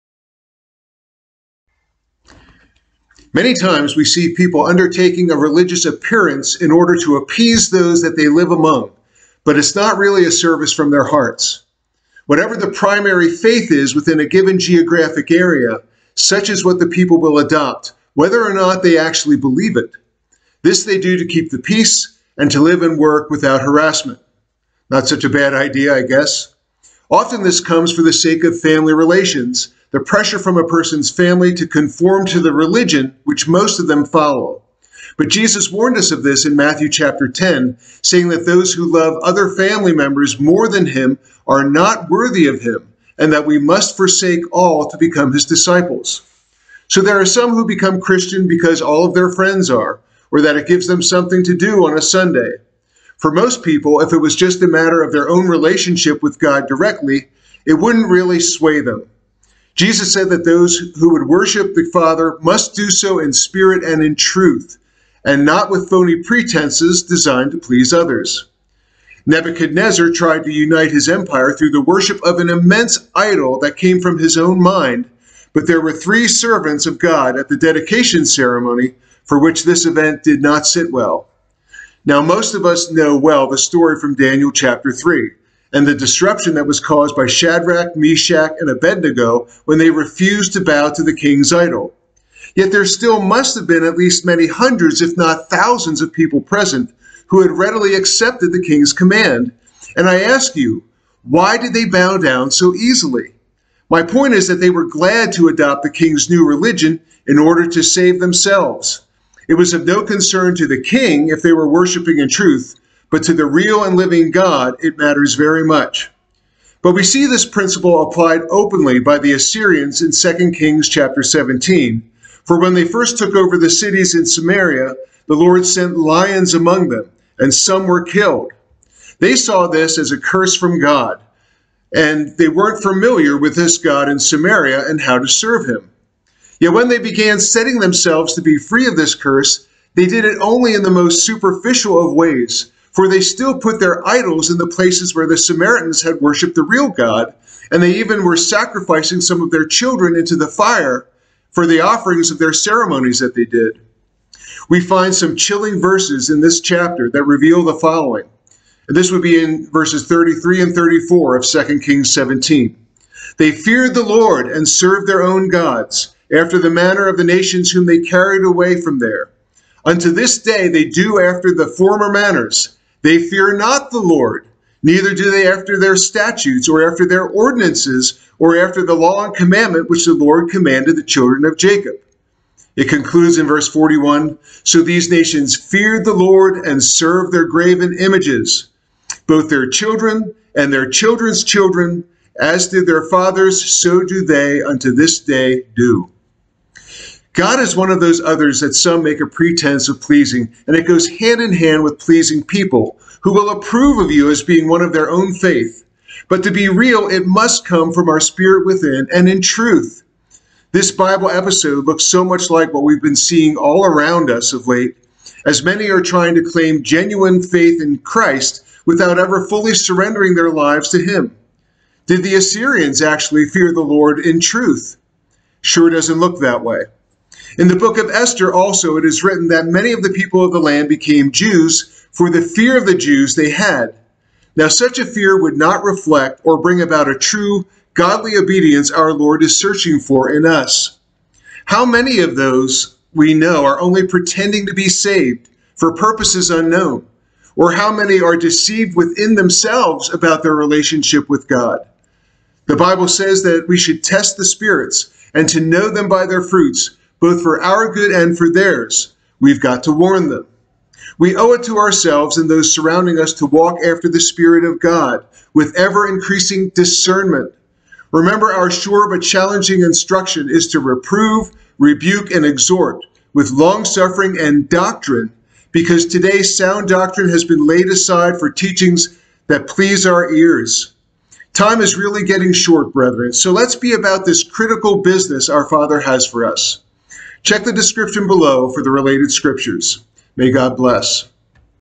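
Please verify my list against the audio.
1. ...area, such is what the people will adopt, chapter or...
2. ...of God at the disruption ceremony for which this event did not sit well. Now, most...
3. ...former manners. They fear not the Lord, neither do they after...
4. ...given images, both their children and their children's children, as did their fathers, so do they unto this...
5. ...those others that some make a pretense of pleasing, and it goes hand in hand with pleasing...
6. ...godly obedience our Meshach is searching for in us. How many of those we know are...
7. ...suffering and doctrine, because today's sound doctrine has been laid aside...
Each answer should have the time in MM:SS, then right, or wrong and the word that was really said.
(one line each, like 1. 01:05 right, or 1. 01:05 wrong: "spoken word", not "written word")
1. 00:15 wrong: "whether", not "chapter"
2. 01:16 wrong: "dedication", not "disruption"
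3. 02:51 right
4. 03:07 wrong: "graven", not "given"
5. 03:18 right
6. 03:57 wrong: "Lord", not "Meshach"
7. 04:33 right.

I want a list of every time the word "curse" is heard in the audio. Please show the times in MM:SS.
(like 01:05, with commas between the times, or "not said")
02:10, 02:19.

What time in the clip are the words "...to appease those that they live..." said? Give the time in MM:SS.
00:06.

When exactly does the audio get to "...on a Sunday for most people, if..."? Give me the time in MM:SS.
00:51.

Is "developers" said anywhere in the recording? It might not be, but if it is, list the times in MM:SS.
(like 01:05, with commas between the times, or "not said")
not said.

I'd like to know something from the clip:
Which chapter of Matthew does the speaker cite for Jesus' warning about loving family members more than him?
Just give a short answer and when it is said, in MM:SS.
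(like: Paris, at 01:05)
Chapter 10, at 00:36.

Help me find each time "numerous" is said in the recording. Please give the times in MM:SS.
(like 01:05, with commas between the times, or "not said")
not said.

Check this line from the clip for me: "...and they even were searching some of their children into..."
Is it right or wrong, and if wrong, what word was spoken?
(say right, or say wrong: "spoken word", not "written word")
wrong: "sacrificing", not "searching".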